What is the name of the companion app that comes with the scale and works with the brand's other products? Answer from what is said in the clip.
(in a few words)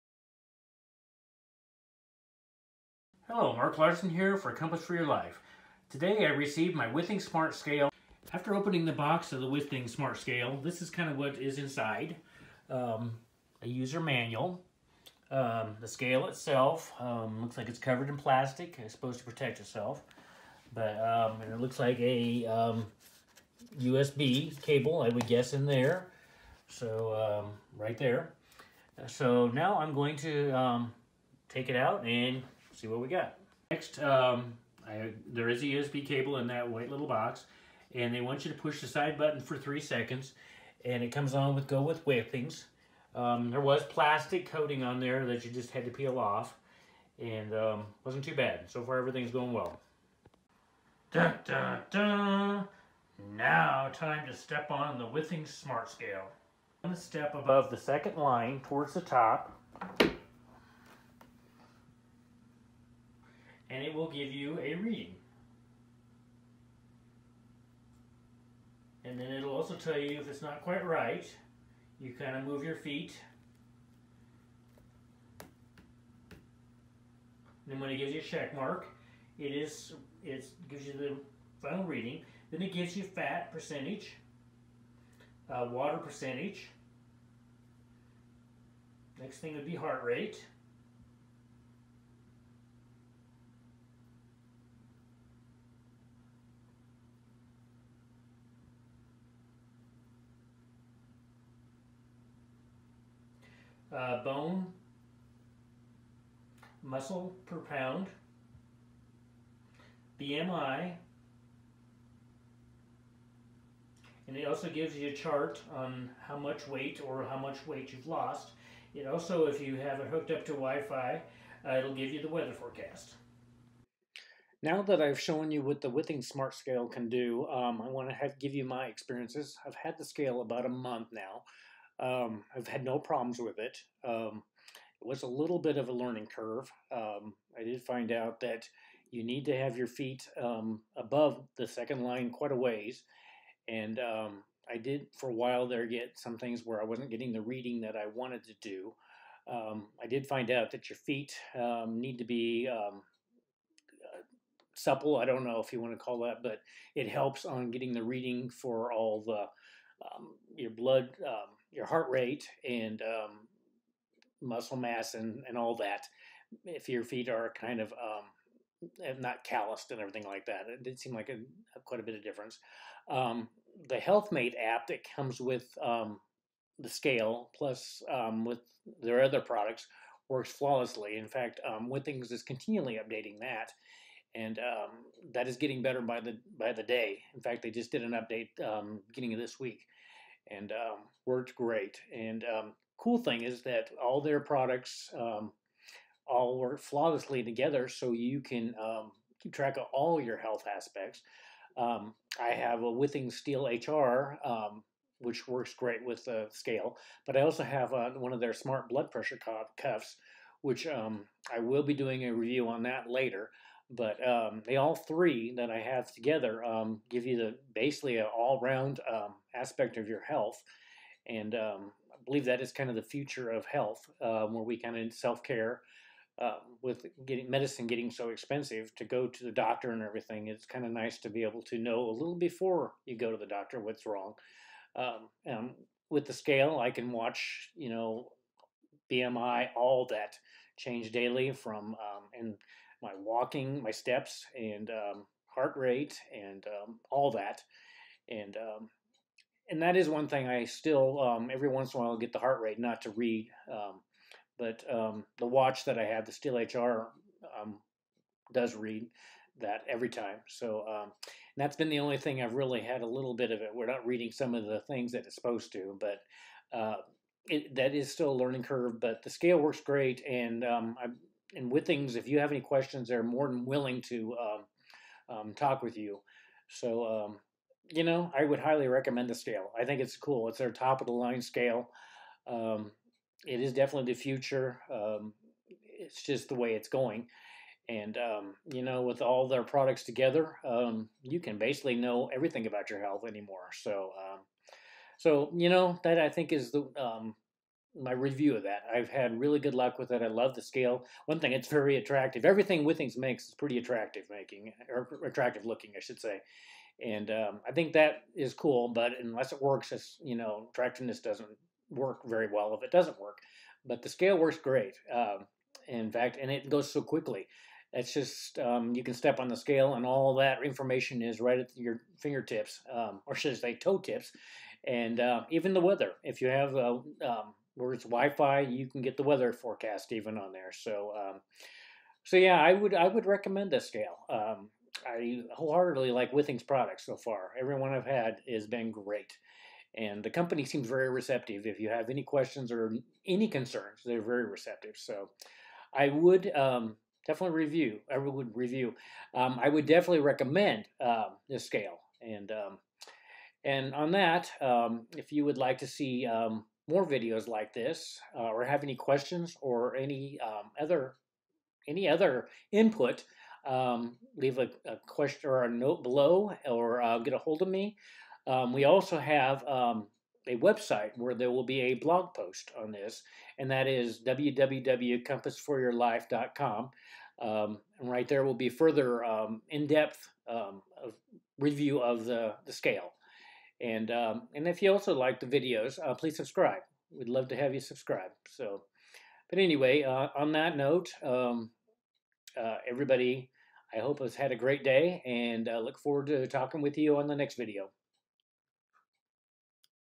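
HealthMate.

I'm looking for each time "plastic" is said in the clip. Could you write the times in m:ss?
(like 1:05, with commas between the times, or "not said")
0:18, 0:43.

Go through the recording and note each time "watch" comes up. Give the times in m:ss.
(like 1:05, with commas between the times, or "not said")
3:57, 4:15.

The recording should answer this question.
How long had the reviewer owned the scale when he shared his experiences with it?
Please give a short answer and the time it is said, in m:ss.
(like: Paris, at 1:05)
About a month, at 2:10.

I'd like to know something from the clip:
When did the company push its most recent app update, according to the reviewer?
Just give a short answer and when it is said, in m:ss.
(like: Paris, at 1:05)
Beginning of this week, at 3:09.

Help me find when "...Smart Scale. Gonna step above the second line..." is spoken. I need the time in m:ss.
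0:55.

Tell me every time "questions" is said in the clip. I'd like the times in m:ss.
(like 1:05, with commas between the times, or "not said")
4:32, 5:42, 5:58, 6:05.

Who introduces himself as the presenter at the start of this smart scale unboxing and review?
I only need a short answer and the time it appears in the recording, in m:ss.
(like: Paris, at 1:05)
Mark Larson, at 0:03.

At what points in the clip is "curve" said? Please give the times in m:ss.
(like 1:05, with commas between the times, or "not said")
2:16, 4:28.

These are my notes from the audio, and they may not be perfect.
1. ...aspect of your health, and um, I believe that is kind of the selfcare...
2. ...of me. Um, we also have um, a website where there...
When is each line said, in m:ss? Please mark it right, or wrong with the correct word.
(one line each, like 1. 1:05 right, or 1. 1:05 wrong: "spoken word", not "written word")
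1. 3:39 wrong: "future", not "selfcare"
2. 6:07 right.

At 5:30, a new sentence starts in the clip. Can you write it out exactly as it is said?
So, um, so yeah, I would I would recommend this scale.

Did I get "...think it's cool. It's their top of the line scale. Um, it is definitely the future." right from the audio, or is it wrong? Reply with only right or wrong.
right.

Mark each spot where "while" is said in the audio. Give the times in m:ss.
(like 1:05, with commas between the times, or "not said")
2:25, 4:12.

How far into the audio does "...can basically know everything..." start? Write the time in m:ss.
4:51.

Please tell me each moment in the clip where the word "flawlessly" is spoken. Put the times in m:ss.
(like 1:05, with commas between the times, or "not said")
3:00, 3:16.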